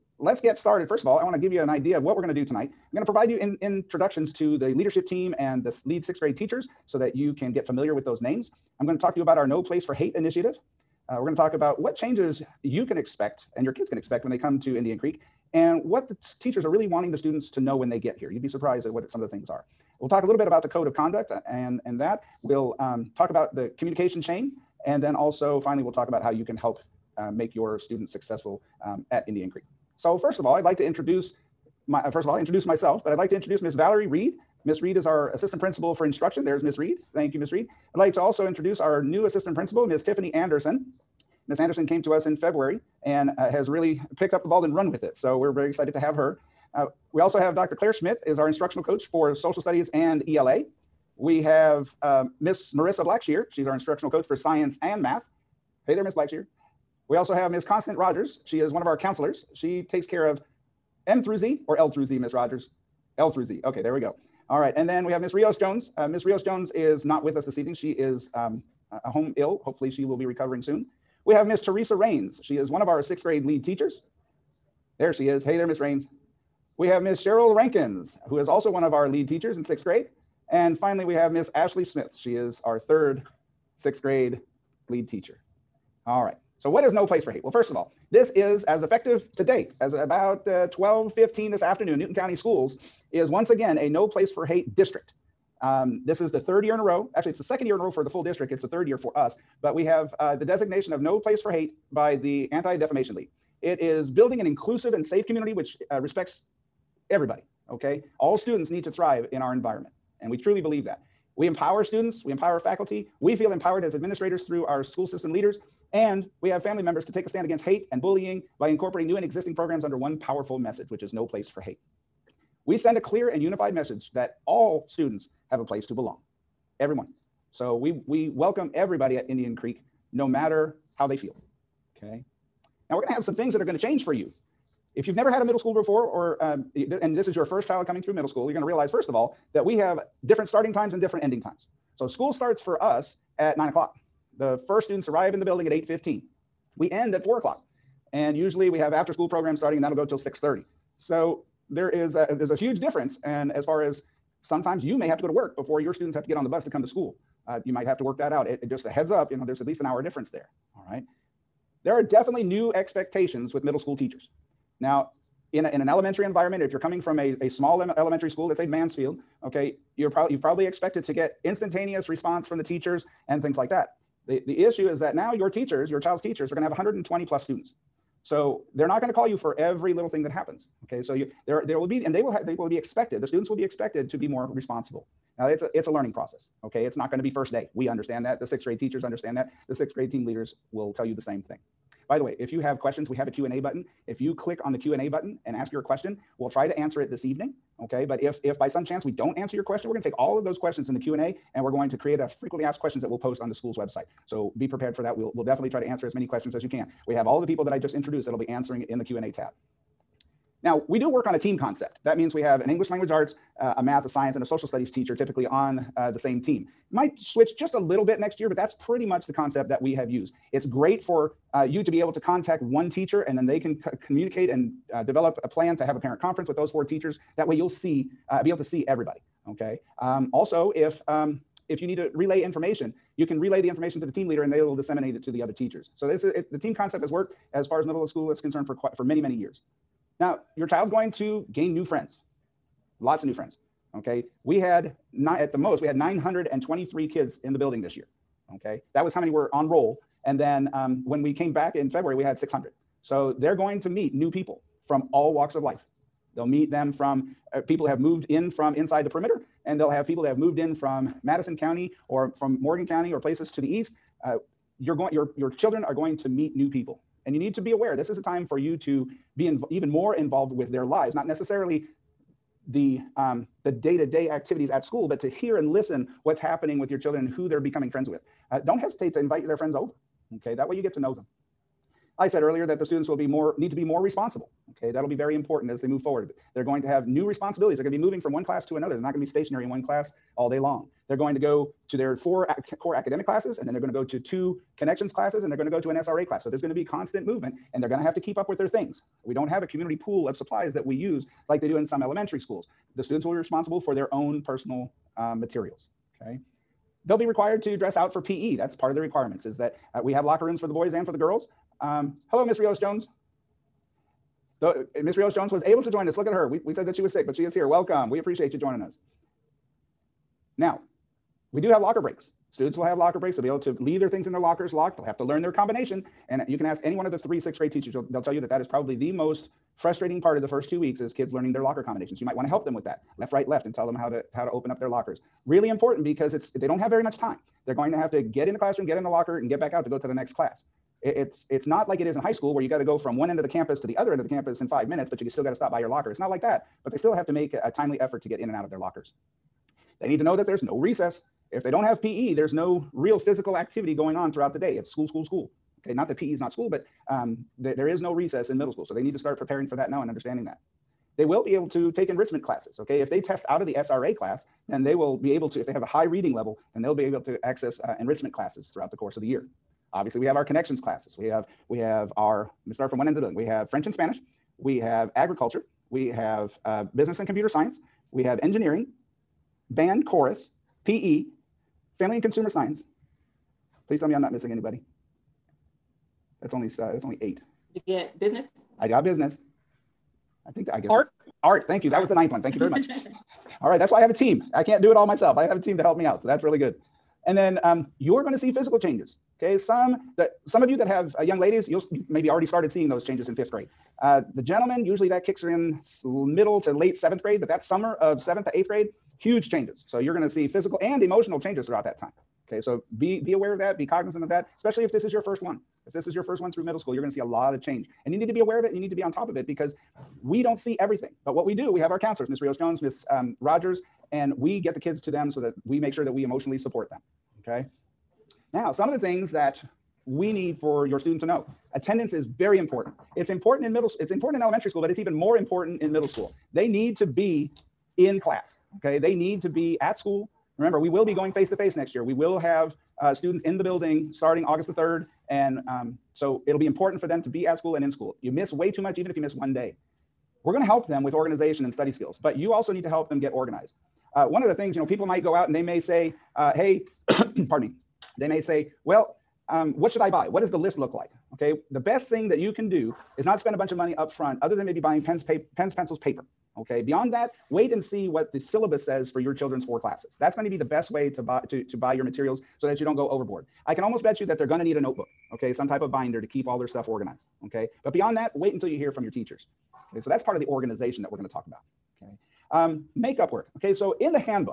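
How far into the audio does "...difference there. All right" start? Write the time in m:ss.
2:40.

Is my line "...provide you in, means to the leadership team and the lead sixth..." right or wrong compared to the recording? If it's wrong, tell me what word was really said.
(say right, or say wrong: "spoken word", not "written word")
wrong: "introductions", not "means".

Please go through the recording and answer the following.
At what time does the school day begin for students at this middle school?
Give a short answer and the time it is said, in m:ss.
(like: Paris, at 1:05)
9:00, at 2:23.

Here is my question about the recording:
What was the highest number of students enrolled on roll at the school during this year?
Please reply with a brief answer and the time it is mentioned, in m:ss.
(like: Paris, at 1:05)
923, at 4:05.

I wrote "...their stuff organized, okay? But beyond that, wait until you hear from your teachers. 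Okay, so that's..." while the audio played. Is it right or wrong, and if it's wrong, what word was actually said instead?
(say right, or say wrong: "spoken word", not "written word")
right.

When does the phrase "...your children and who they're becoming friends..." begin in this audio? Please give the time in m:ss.
4:36.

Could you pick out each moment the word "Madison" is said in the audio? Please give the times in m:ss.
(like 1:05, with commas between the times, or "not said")
4:21.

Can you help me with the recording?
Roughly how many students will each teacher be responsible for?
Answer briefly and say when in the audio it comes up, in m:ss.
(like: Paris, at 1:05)
120 plus, at 2:56.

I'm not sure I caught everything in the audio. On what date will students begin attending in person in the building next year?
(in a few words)
August 3.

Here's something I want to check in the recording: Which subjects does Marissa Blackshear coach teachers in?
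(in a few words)
Science and math.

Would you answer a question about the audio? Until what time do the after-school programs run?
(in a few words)
6:30.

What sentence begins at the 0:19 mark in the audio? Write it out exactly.
We'll talk a little bit about the code of conduct uh, and, and that.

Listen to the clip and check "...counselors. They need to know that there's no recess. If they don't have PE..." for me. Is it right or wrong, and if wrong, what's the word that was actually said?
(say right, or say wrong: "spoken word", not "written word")
wrong: "lockers", not "counselors".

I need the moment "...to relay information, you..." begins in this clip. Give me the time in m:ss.
3:51.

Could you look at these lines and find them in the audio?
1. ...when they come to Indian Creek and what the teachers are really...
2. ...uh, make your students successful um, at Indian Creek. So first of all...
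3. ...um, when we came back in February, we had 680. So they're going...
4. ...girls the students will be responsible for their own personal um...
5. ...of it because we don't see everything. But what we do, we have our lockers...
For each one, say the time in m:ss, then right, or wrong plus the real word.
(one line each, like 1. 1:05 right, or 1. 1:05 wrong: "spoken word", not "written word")
1. 0:14 right
2. 0:27 right
3. 4:10 wrong: "600", not "680"
4. 5:02 wrong: "schools", not "girls"
5. 6:59 wrong: "counselors", not "lockers".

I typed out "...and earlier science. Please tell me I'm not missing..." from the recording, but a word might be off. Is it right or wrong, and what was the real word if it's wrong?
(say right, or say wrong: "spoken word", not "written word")
wrong: "consumer", not "earlier".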